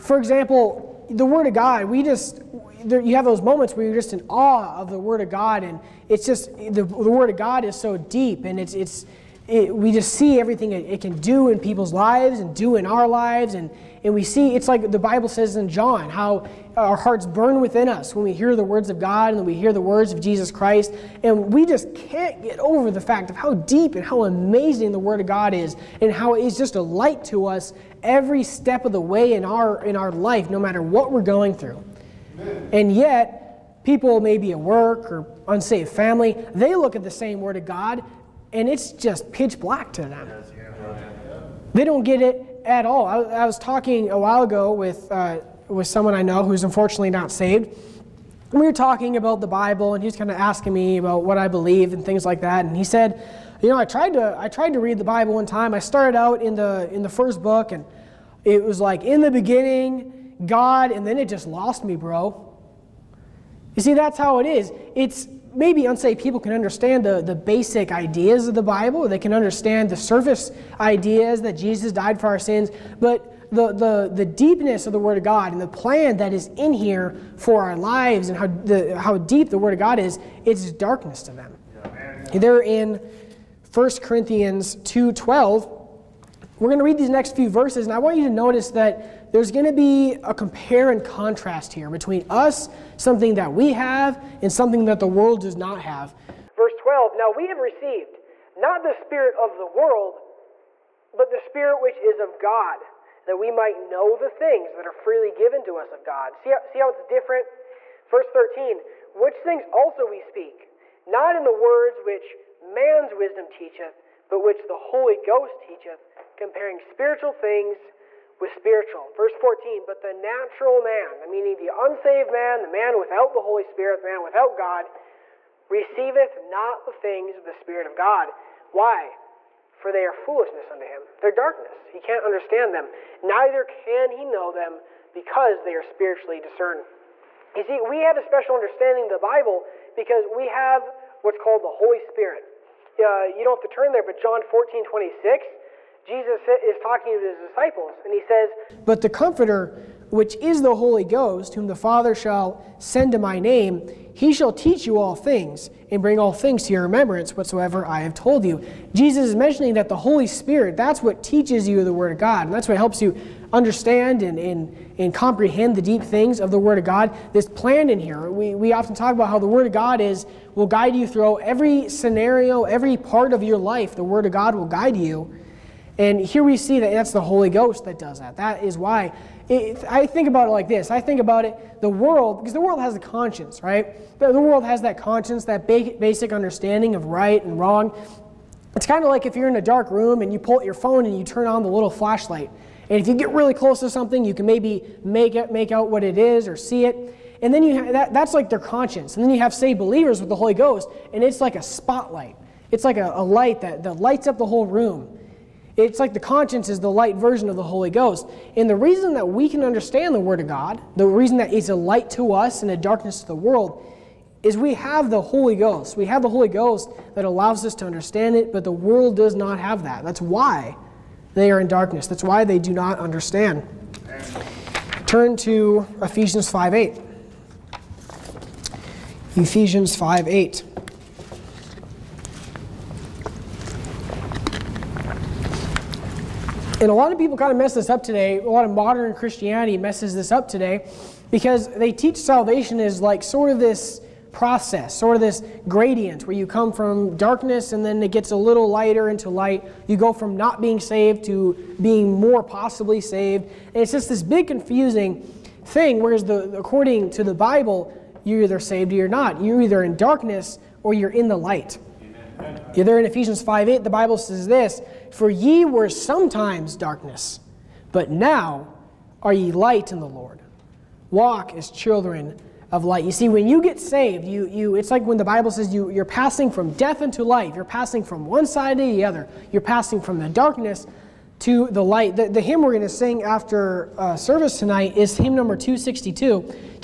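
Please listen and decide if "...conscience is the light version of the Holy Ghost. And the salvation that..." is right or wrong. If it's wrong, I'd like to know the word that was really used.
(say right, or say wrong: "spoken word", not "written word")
wrong: "reason", not "salvation".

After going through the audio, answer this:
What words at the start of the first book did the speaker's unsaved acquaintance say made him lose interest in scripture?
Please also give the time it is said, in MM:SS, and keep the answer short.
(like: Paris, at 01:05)
in the beginning, God, at 00:59.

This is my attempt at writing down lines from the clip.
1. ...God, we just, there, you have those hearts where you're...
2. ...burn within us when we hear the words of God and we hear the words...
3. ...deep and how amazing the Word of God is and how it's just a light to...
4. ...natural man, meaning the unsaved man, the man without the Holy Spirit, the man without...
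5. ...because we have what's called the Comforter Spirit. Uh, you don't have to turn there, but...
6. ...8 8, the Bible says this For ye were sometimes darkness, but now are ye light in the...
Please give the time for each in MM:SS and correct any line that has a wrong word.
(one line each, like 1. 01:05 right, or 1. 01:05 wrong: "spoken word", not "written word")
1. 00:01 wrong: "moments", not "hearts"
2. 00:17 right
3. 00:23 right
4. 02:00 right
5. 02:19 wrong: "Holy", not "Comforter"
6. 04:23 wrong: "5", not "8".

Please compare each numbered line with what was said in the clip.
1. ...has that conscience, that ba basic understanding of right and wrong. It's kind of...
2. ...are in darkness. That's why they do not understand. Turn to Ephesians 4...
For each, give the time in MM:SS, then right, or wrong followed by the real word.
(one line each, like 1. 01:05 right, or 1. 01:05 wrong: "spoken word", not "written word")
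1. 03:04 right
2. 03:41 wrong: "5", not "4".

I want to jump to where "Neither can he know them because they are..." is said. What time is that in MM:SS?
02:13.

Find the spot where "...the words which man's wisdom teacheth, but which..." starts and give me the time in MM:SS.
01:51.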